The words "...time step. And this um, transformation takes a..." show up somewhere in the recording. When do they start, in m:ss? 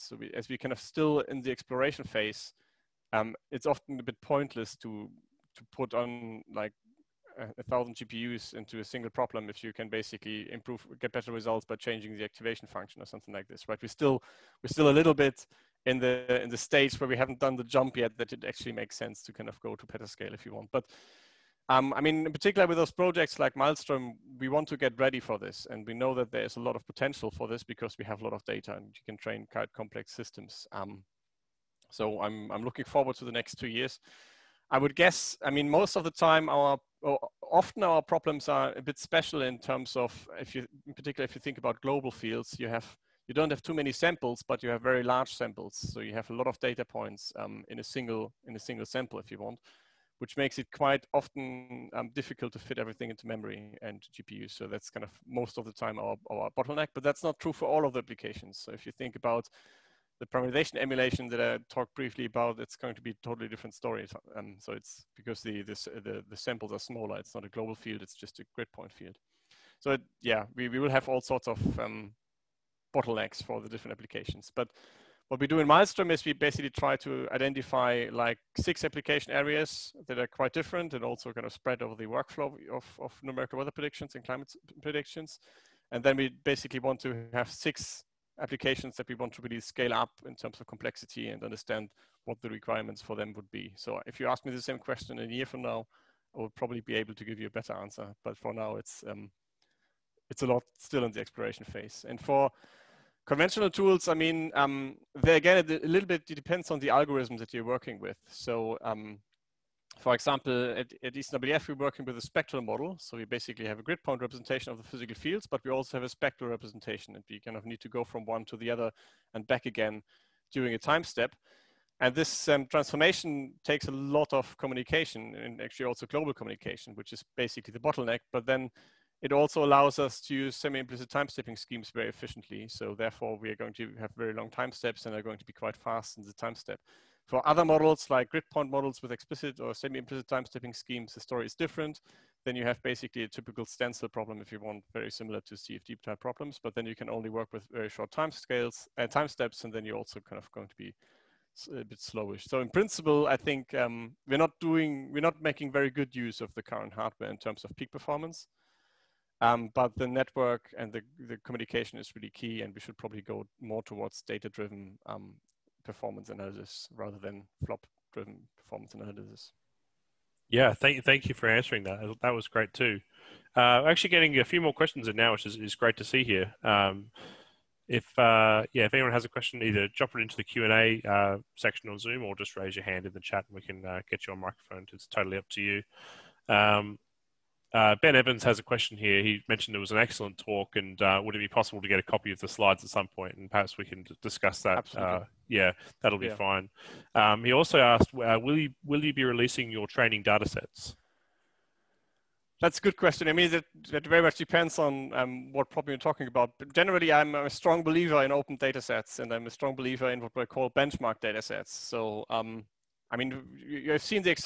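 2:00.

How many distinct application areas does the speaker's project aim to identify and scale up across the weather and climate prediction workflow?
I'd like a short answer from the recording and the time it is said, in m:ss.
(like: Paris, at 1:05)
6, at 1:18.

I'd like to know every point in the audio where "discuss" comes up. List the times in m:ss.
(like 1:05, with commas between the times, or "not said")
3:14.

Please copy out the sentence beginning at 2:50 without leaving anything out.
Yeah, thank thank you for answering that.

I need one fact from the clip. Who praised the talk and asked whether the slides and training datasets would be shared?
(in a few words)
Ben Evans.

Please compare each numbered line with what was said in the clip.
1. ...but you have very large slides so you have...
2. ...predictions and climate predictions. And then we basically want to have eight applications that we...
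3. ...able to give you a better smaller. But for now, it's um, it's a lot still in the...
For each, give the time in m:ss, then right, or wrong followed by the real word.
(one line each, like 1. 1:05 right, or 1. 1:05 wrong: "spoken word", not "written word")
1. 0:44 wrong: "samples", not "slides"
2. 1:23 wrong: "six", not "eight"
3. 1:36 wrong: "answer", not "smaller".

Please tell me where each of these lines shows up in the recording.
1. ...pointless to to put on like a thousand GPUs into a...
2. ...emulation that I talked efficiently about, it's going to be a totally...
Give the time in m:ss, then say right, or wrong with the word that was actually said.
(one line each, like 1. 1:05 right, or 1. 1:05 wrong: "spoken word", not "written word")
1. 0:04 right
2. 1:00 wrong: "briefly", not "efficiently".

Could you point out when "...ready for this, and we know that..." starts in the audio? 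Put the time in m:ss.
0:24.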